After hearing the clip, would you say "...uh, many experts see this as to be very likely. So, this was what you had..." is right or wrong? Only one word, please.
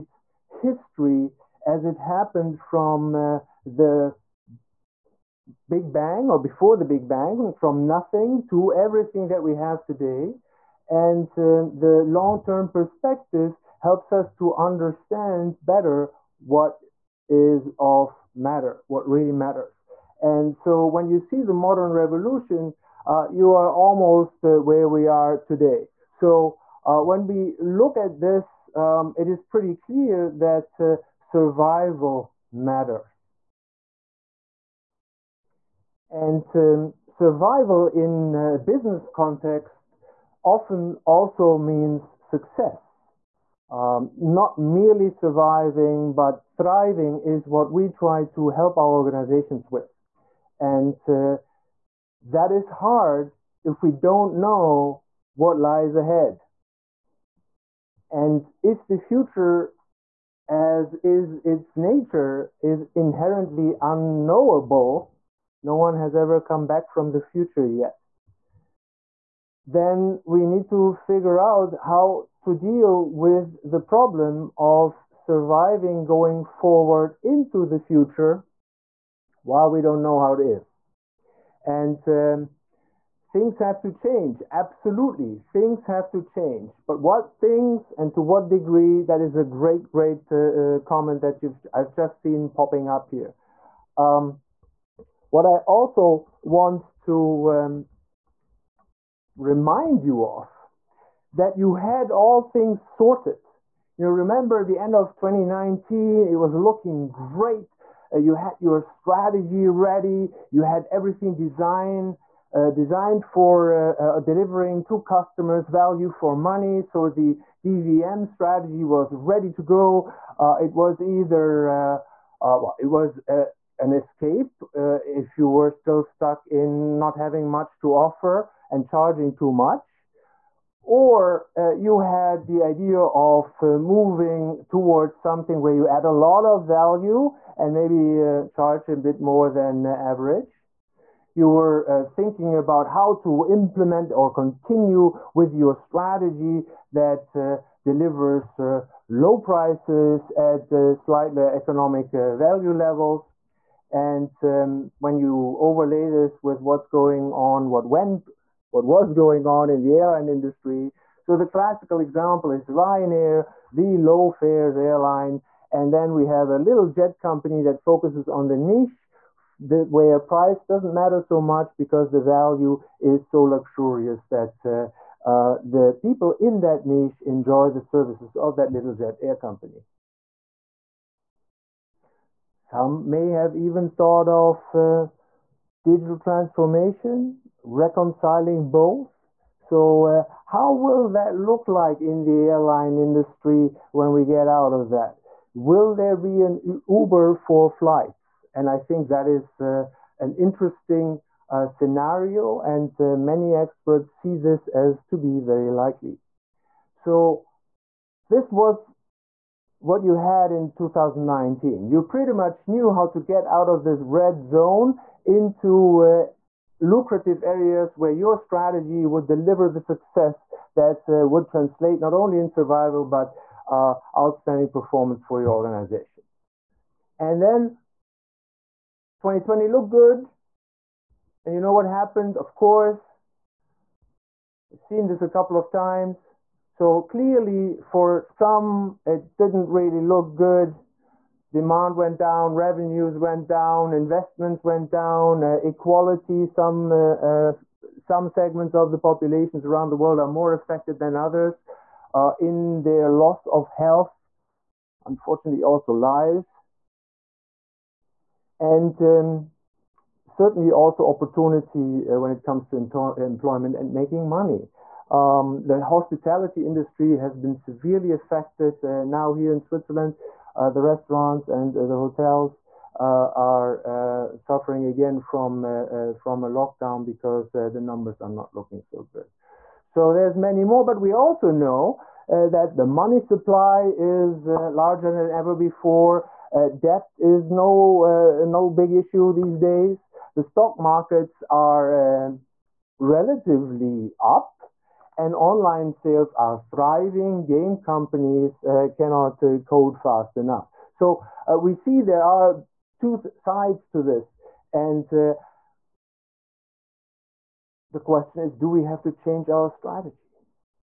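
right.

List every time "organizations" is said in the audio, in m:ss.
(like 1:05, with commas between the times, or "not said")
0:48, 3:45.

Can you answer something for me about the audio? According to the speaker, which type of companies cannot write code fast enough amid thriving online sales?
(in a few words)
Game companies.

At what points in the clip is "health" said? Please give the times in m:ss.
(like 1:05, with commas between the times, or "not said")
4:13.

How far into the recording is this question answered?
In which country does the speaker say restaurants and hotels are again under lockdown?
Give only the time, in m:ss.
4:29.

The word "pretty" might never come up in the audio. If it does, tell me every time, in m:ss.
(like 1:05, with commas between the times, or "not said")
0:29, 3:32.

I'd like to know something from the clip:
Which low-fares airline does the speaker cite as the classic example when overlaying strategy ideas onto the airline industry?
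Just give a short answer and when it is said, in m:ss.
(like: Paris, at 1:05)
Ryanair, at 2:42.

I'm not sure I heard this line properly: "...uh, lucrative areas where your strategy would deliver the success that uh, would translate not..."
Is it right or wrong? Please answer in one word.
right.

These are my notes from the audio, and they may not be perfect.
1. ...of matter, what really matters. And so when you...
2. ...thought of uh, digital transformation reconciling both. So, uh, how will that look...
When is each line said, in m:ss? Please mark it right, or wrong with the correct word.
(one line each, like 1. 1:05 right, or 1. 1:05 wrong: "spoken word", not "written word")
1. 0:17 right
2. 3:03 right.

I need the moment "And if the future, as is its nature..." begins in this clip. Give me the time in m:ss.
0:58.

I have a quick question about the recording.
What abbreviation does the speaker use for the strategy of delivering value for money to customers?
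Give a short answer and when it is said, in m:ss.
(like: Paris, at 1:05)
DVM, at 1:57.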